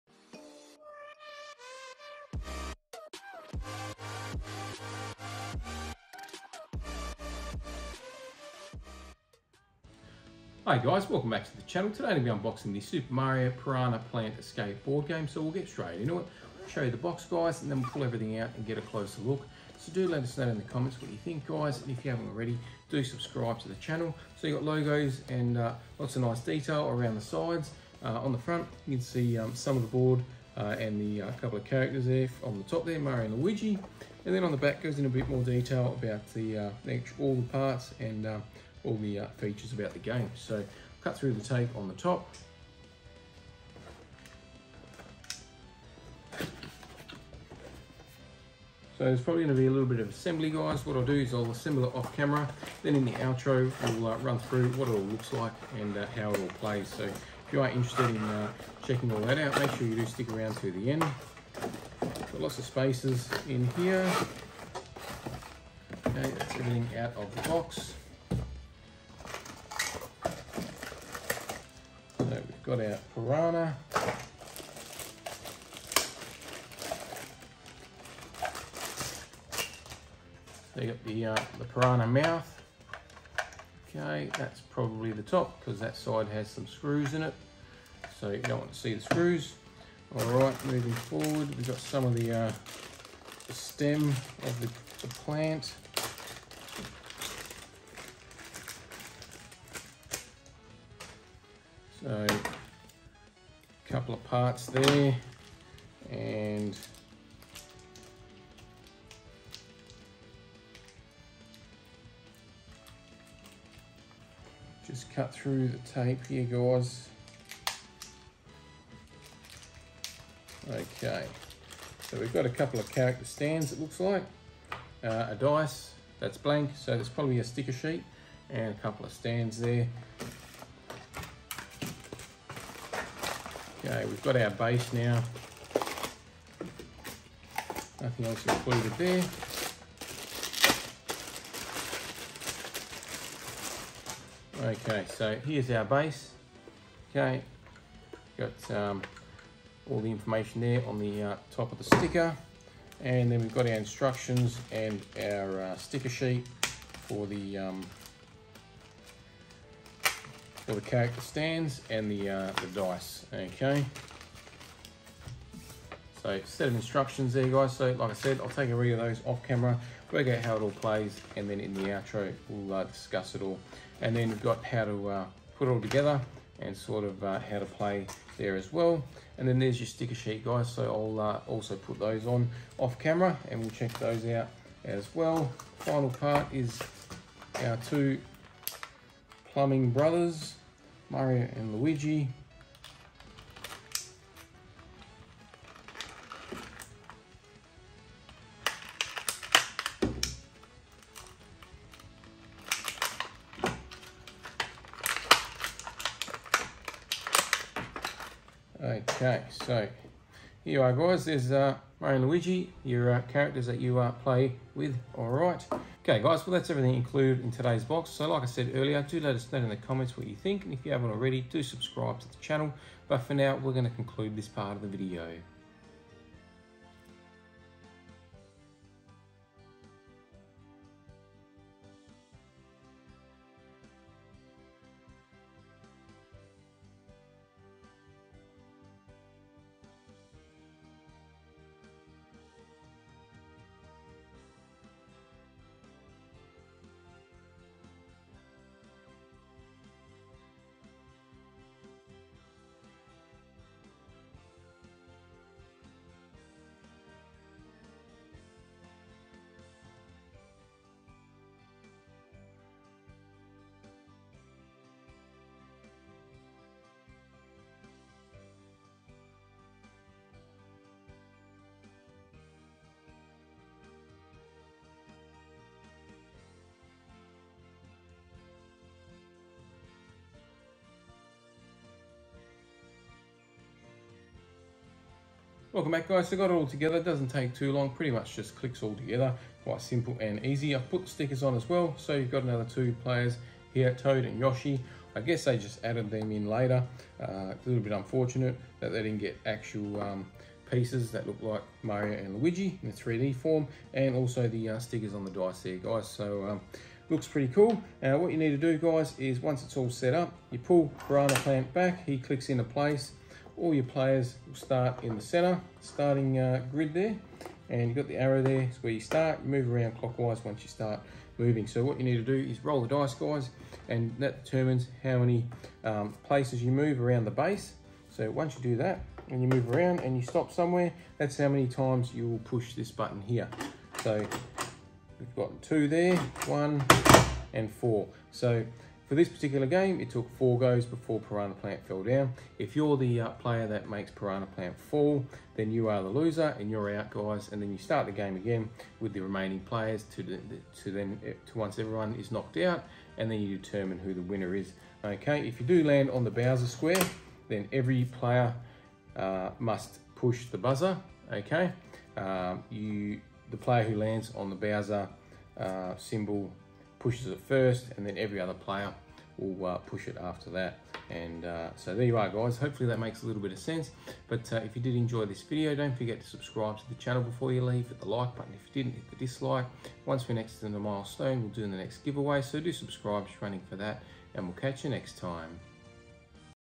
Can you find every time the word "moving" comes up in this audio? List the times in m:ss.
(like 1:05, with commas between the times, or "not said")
1:30, 5:21.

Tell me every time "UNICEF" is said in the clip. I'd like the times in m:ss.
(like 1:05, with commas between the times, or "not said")
not said.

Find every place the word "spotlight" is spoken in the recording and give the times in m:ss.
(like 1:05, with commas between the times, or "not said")
not said.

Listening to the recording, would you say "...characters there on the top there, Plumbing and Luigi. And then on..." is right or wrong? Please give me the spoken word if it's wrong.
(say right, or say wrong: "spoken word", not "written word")
wrong: "Mario", not "Plumbing".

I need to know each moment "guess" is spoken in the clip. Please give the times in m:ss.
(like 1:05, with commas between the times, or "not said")
4:55.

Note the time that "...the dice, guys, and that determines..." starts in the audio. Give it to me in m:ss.
5:22.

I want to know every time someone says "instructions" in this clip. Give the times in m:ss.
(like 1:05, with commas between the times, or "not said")
2:33, 2:46.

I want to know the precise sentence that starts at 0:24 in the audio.
So you got logos and uh, lots of nice detail around the sides.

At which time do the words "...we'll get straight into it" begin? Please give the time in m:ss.
0:15.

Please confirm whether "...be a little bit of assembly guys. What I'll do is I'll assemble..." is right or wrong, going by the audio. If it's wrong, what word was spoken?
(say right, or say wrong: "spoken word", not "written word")
right.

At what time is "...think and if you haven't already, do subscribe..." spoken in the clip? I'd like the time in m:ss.
3:40.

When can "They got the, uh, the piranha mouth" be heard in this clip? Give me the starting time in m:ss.
1:20.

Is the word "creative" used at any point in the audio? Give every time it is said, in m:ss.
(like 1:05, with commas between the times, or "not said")
not said.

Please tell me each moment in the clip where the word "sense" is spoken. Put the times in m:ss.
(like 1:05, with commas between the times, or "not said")
6:13.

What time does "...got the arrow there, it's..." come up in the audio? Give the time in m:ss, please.
5:17.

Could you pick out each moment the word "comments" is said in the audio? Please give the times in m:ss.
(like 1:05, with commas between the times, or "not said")
0:20, 3:39.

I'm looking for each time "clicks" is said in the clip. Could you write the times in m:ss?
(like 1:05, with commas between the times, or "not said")
4:48, 5:12.